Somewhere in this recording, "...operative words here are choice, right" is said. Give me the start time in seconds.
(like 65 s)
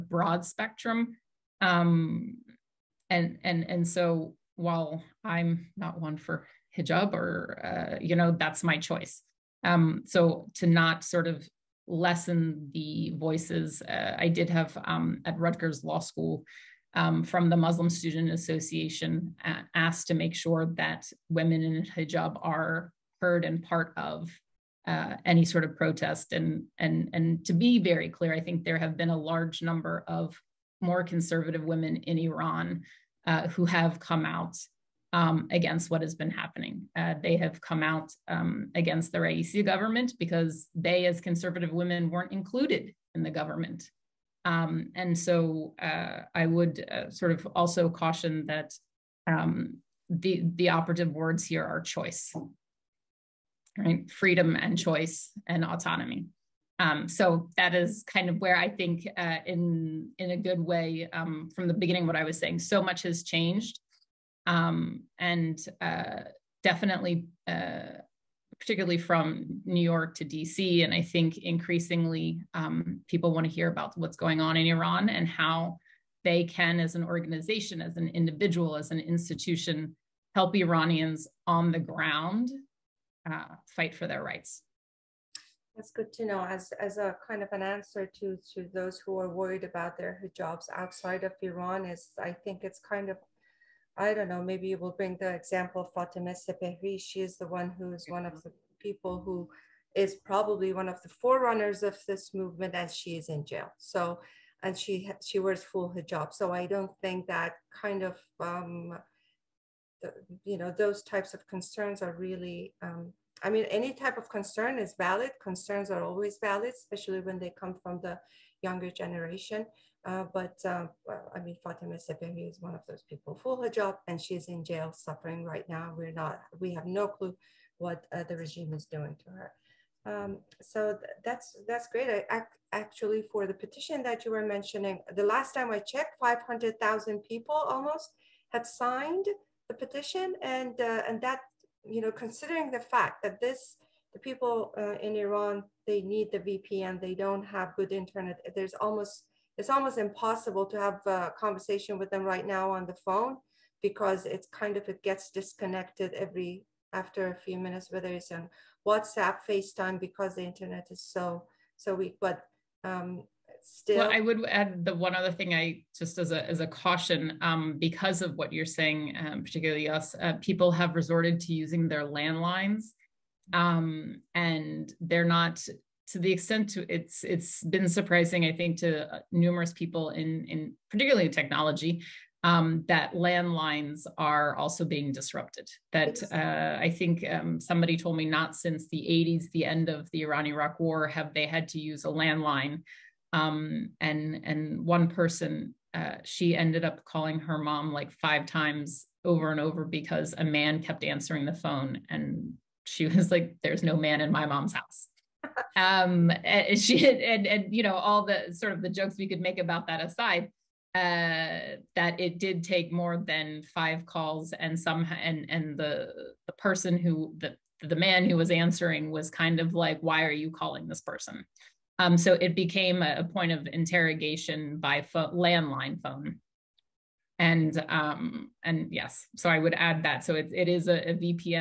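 50 s.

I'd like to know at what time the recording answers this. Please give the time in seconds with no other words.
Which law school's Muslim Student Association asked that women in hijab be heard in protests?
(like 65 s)
15 s.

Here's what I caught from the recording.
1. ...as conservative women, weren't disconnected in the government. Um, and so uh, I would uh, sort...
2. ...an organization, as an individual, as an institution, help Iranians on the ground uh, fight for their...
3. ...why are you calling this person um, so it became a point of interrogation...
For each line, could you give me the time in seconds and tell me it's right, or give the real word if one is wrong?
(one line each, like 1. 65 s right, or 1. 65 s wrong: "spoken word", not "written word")
1. 41 s wrong: "included", not "disconnected"
2. 76 s right
3. 220 s right.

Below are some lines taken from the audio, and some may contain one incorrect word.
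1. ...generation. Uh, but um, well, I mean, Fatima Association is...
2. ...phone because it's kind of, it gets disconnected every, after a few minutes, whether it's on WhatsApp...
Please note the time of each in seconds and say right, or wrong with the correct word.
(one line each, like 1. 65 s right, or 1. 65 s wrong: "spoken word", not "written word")
1. 118 s wrong: "Sepehri", not "Association"
2. 152 s right.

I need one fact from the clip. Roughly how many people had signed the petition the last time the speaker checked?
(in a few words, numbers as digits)
500,000.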